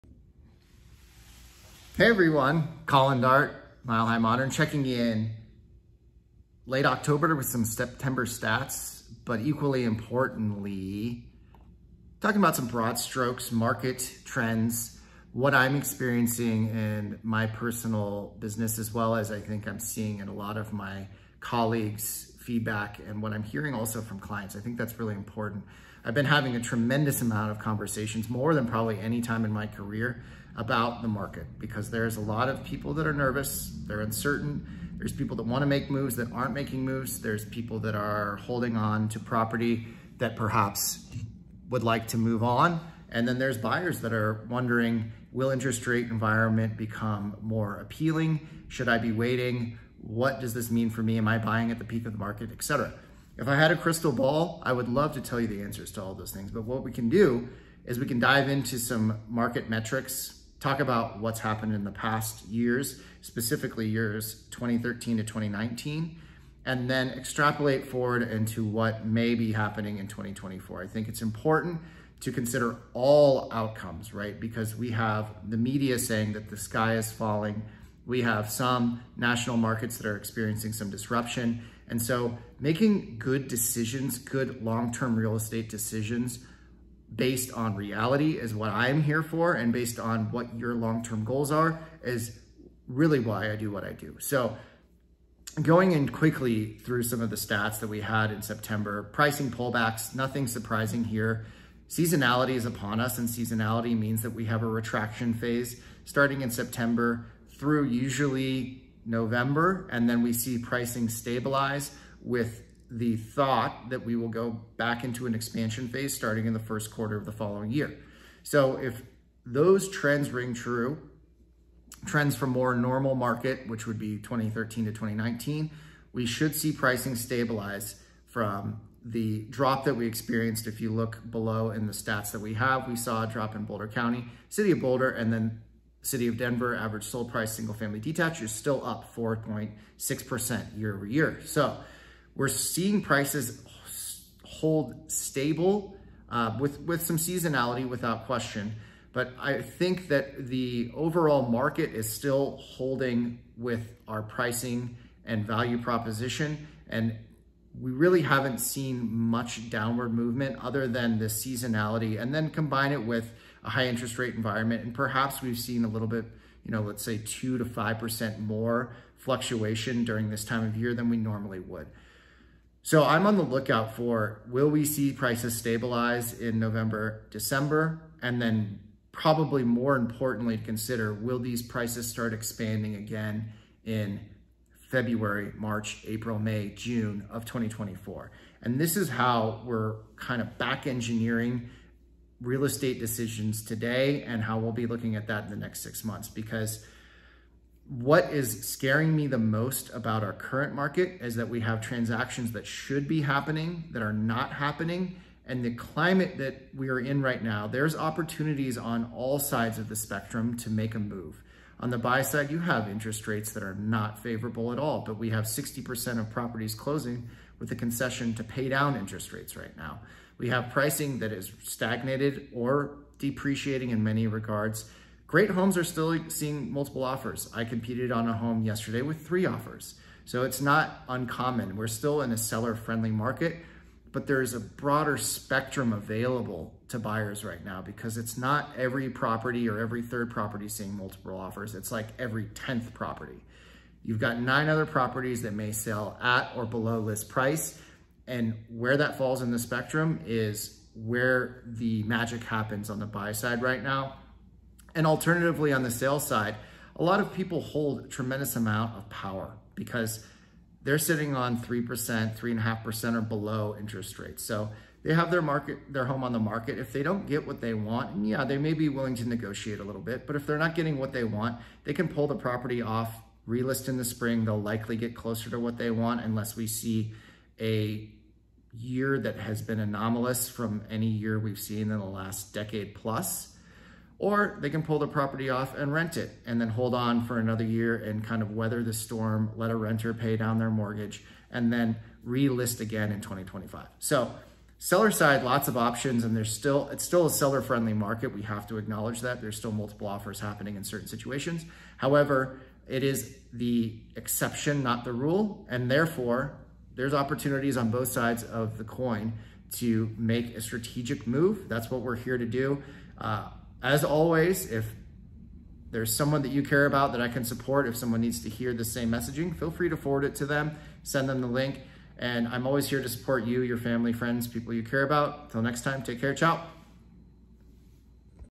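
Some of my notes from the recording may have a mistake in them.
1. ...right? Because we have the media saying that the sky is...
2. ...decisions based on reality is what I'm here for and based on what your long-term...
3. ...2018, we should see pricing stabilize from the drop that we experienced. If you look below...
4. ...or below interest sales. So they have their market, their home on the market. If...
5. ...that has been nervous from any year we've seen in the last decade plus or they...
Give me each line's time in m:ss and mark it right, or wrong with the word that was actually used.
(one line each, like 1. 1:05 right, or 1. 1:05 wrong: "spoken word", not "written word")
1. 1:14 right
2. 1:25 right
3. 2:04 wrong: "2019", not "2018"
4. 4:23 wrong: "rates", not "sales"
5. 4:39 wrong: "anomalous", not "nervous".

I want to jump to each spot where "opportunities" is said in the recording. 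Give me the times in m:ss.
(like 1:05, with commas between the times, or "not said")
3:27, 5:07.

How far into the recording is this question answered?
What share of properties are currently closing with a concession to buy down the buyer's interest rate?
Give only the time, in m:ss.
3:35.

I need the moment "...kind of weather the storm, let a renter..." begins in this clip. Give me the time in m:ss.
4:48.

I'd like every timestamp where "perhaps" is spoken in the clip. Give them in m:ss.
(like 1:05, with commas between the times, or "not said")
0:40, 2:44.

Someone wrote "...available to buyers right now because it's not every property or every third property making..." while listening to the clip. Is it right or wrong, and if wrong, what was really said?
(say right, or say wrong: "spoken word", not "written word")
wrong: "seeing", not "making".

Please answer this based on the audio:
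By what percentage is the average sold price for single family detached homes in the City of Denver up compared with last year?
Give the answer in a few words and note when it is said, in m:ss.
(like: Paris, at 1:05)
4.6%, at 2:19.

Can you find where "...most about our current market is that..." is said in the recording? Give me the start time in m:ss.
3:19.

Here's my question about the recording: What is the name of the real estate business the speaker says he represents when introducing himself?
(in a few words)
Mile High Modern.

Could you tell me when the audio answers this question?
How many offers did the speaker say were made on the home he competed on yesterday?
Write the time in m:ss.
3:49.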